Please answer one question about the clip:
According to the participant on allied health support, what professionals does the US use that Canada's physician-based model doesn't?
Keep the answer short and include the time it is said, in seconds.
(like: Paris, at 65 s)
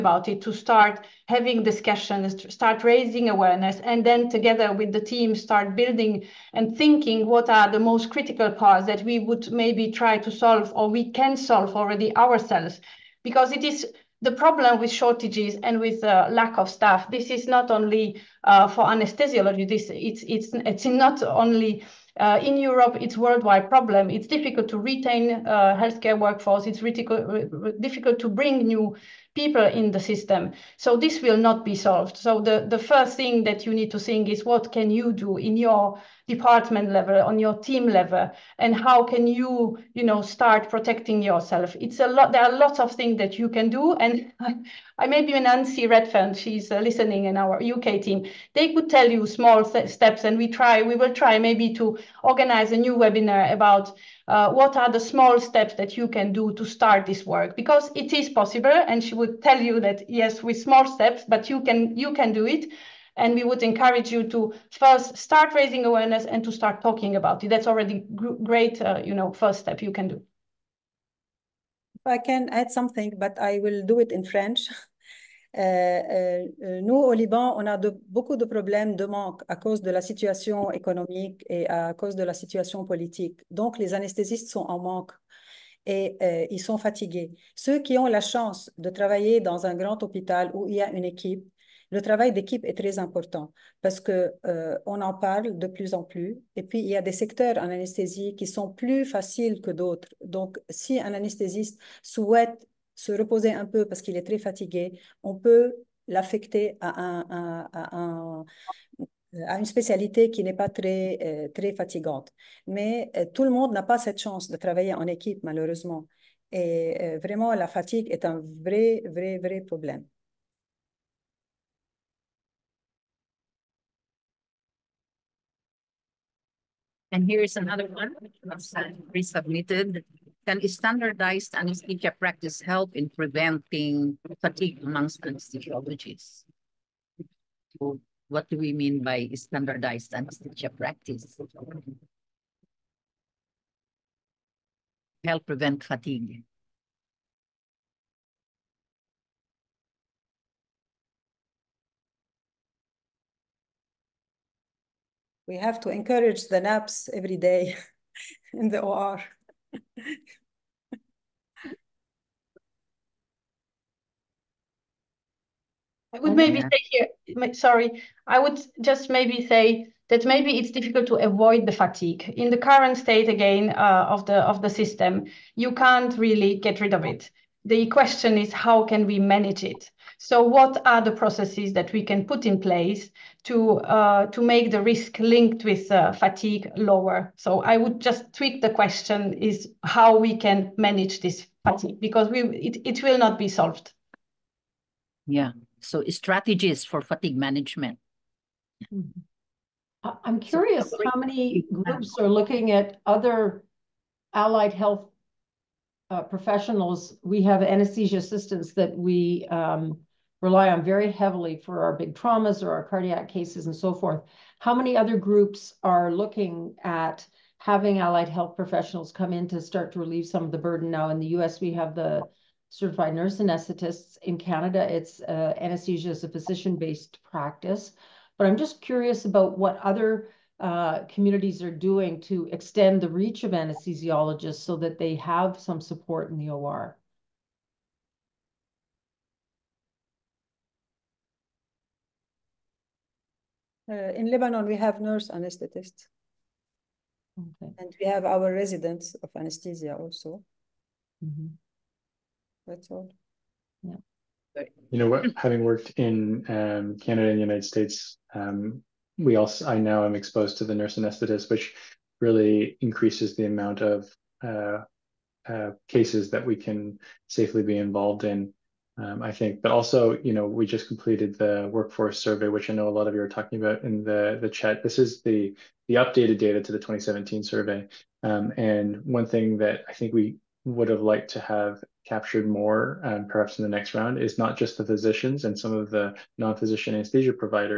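certified nurse anesthetists, at 222 s.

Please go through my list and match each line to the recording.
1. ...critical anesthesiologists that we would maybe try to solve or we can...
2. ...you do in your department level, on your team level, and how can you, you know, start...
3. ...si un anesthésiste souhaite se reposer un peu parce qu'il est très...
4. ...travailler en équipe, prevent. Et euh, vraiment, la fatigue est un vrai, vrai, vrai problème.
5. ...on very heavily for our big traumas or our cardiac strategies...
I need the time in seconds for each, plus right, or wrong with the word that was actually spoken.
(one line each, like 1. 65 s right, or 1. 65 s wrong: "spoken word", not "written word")
1. 8 s wrong: "parts", not "anesthesiologists"
2. 34 s right
3. 100 s right
4. 114 s wrong: "malheureusement", not "prevent"
5. 210 s wrong: "cases", not "strategies".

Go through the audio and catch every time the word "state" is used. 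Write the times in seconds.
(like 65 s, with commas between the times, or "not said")
172 s, 257 s.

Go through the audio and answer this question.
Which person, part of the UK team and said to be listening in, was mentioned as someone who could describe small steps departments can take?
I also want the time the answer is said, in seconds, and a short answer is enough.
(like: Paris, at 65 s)
Nancy Redfern, at 45 s.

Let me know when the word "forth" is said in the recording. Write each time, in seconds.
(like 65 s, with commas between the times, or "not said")
213 s.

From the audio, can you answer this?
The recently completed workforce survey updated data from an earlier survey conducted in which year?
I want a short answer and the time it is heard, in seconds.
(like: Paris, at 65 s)
2017, at 276 s.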